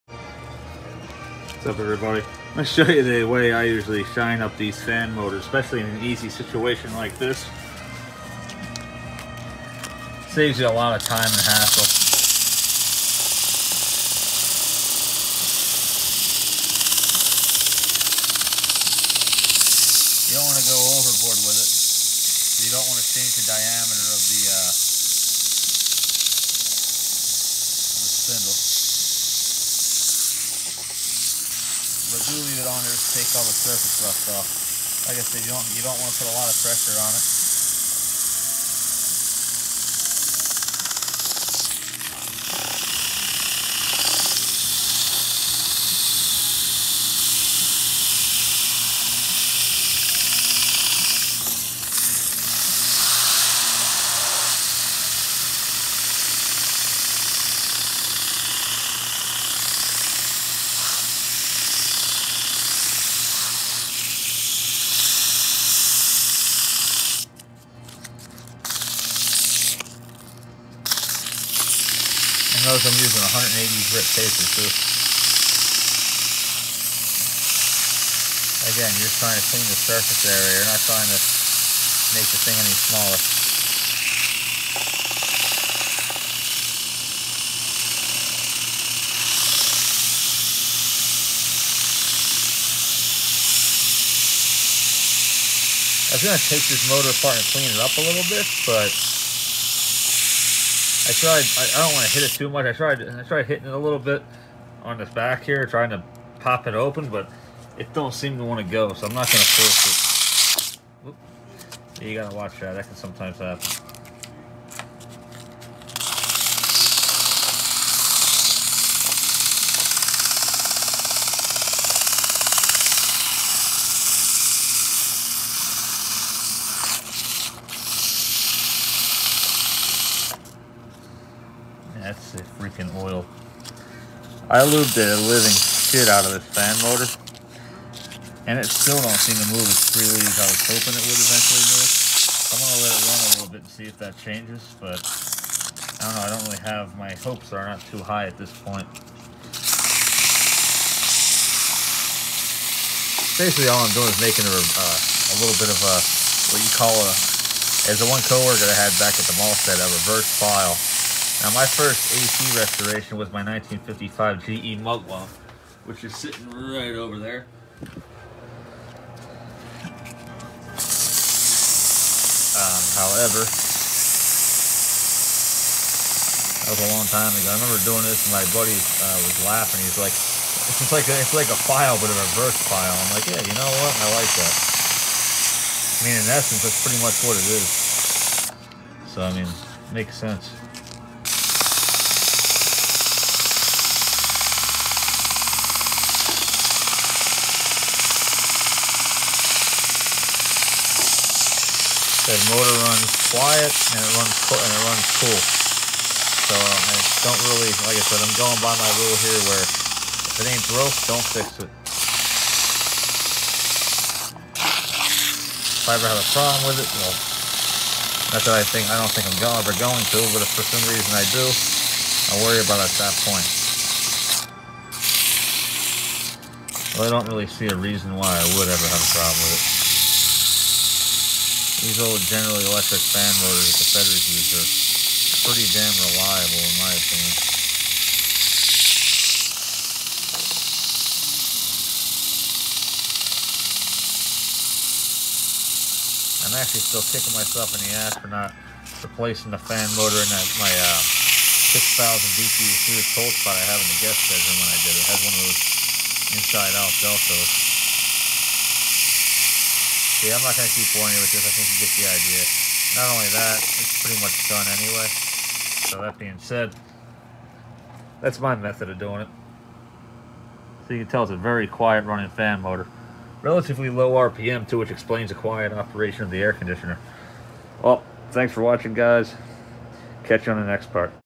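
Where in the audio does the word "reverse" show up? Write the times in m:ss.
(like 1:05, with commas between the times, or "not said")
2:40, 3:02.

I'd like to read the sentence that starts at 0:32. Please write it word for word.
but do leave it on there to take all the surface rust off.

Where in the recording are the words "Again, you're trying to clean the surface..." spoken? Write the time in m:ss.
1:18.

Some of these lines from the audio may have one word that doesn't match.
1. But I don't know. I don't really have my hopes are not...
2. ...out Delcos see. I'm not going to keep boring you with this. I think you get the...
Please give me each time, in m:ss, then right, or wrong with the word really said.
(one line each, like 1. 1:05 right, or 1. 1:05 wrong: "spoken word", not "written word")
1. 2:24 right
2. 4:16 right.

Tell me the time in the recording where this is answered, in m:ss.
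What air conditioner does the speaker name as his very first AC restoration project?
2:43.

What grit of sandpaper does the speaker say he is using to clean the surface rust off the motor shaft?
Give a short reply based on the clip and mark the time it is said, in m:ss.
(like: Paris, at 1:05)
180, at 1:13.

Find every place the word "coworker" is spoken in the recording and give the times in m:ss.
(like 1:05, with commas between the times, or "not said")
2:38.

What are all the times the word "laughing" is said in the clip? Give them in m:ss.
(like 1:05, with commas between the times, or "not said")
2:59.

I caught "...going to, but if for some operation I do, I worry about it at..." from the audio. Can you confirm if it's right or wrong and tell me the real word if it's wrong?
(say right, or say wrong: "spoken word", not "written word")
wrong: "reason", not "operation".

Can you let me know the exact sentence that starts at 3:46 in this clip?
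Well, I don't really see a reason why I would ever have a problem with it.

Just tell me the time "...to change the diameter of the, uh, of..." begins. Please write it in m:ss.
0:22.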